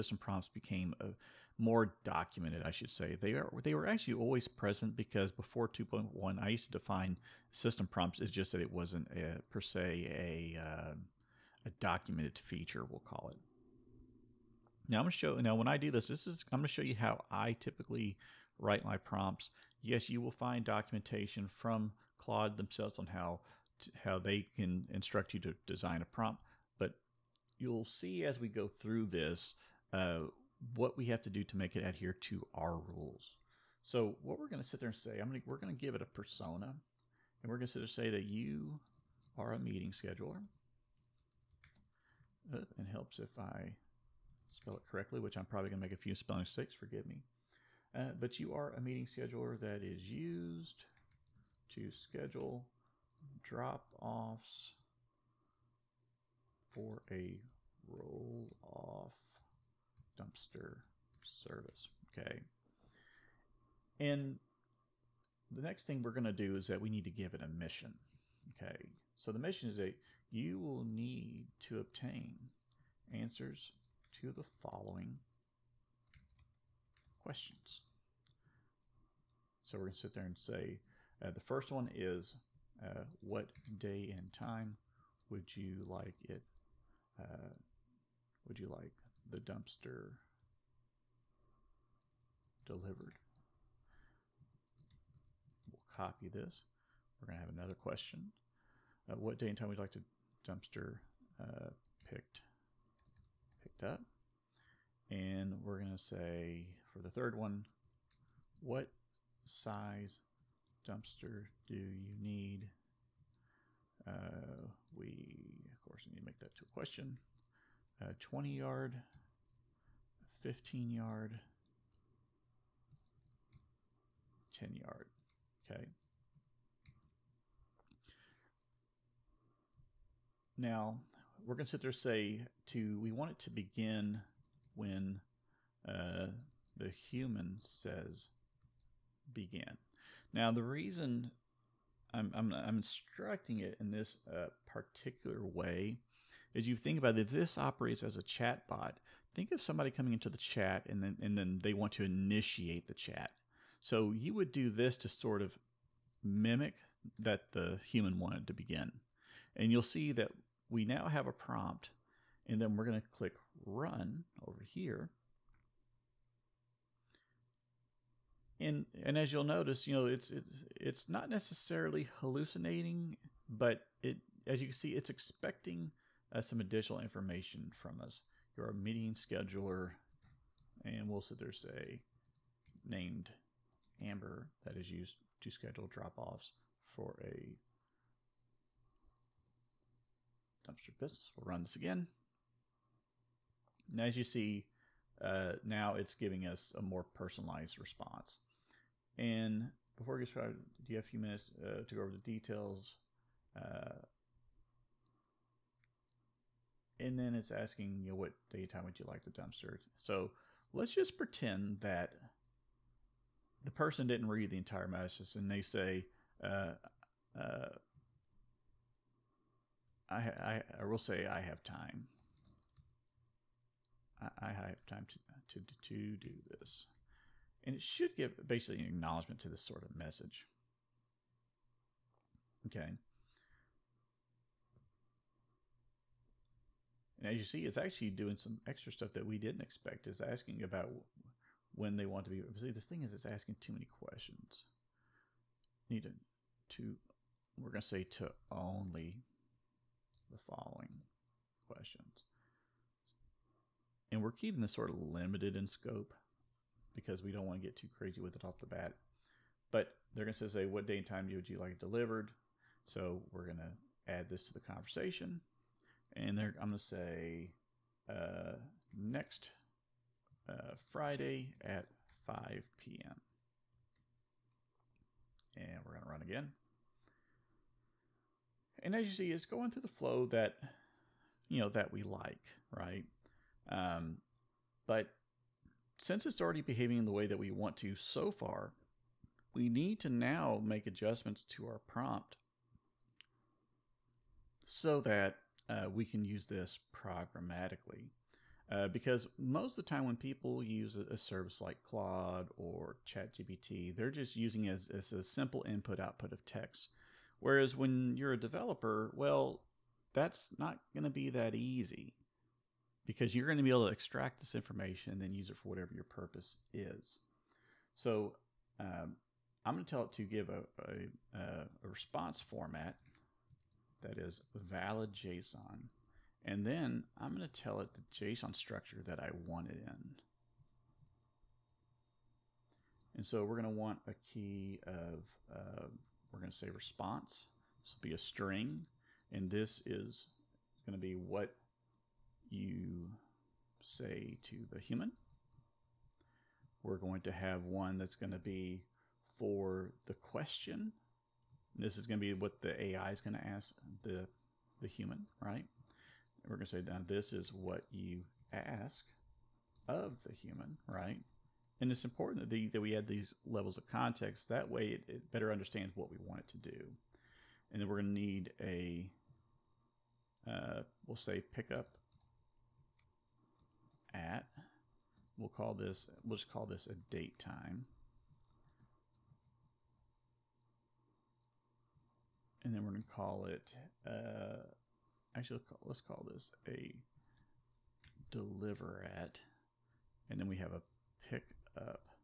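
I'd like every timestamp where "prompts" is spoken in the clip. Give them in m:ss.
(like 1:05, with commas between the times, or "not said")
0:00, 0:07, 0:18, 0:26, 2:41, 4:51.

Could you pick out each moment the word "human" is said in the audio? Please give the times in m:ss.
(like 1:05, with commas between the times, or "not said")
2:16, 2:37, 5:44, 5:54, 6:00.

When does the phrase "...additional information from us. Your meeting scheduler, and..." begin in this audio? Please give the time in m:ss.
2:56.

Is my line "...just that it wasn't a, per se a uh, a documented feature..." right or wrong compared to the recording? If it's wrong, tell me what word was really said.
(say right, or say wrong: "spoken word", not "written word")
right.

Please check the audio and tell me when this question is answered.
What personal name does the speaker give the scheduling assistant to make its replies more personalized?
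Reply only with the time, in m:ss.
3:04.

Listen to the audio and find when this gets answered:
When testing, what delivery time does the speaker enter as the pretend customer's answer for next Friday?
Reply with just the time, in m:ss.
4:32.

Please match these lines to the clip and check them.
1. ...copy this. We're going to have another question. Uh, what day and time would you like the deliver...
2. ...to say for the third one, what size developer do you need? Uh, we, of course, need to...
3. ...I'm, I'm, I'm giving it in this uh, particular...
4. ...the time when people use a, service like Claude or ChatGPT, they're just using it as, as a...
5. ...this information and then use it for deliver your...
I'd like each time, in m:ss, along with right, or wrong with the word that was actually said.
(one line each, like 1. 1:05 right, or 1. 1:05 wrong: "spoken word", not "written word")
1. 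1:35 wrong: "dumpster", not "deliver"
2. 1:45 wrong: "dumpster", not "developer"
3. 2:22 wrong: "instructing", not "giving"
4. 4:59 right
5. 5:14 wrong: "whatever", not "deliver".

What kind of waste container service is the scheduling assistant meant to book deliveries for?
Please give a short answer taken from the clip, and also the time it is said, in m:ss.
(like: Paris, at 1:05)
roll-off dumpster, at 0:57.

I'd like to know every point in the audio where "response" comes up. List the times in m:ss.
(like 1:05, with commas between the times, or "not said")
3:17, 5:21, 5:36.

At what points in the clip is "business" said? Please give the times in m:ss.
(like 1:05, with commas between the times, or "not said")
3:10.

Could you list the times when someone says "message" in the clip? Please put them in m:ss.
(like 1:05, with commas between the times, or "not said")
3:34, 3:49.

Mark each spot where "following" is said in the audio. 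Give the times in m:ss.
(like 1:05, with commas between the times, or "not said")
1:14, 4:10.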